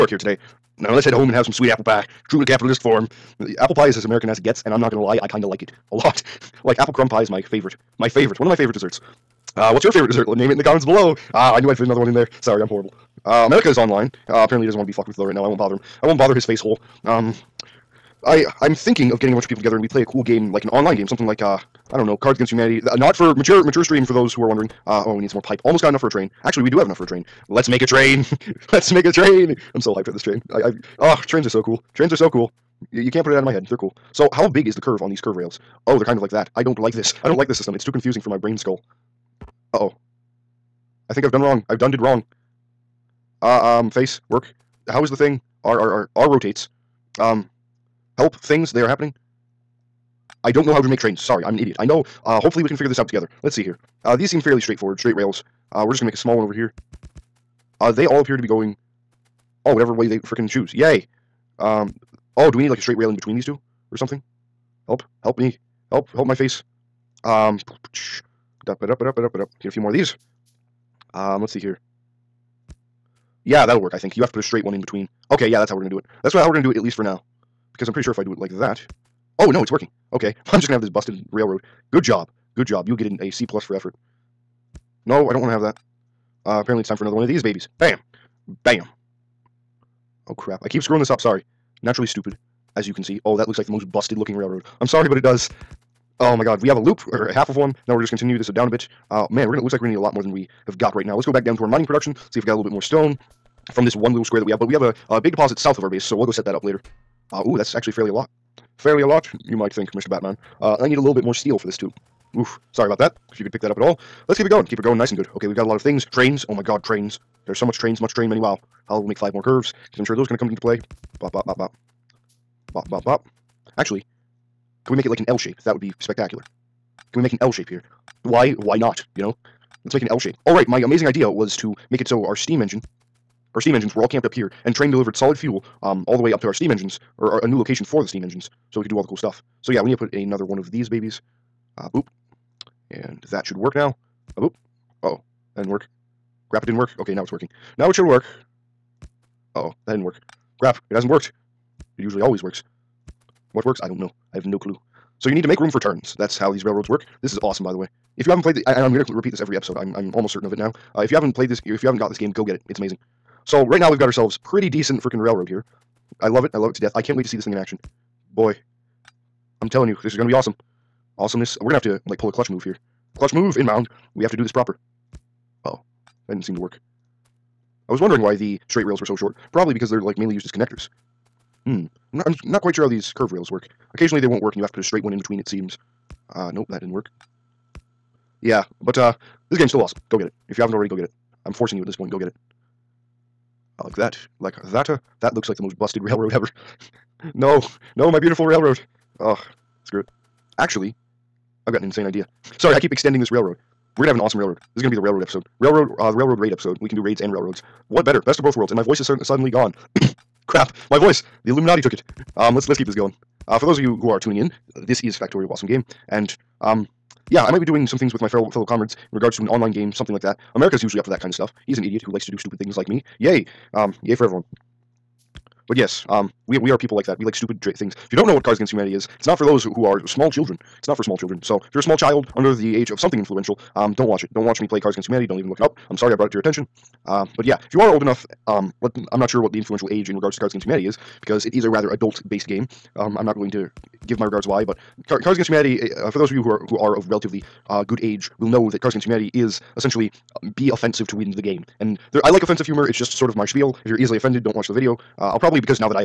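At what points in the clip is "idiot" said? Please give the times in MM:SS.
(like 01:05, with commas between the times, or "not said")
00:51, 03:41.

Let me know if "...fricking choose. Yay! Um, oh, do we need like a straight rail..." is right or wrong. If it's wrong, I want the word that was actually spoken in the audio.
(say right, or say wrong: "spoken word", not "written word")
right.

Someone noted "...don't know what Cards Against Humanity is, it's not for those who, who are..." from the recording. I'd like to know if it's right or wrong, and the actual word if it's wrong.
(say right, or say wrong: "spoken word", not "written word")
right.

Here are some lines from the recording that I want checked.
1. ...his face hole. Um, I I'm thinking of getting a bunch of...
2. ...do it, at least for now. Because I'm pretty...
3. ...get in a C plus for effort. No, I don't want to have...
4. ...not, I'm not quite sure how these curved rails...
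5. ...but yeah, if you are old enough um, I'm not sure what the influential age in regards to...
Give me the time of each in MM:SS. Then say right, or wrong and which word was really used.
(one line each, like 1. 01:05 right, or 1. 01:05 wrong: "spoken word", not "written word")
1. 00:16 right
2. 01:16 right
3. 01:22 right
4. 03:02 right
5. 03:57 right.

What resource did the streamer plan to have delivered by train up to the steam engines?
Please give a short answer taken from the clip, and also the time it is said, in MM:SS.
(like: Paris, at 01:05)
Solid fuel, at 02:15.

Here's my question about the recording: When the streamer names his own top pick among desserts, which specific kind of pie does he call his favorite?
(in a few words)
Apple crumb pie.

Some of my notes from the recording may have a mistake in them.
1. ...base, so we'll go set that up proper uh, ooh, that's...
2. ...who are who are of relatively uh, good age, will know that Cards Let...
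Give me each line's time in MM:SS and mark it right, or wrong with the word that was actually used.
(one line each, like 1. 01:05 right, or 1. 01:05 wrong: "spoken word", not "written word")
1. 01:45 wrong: "later", not "proper"
2. 04:06 wrong: "Against", not "Let".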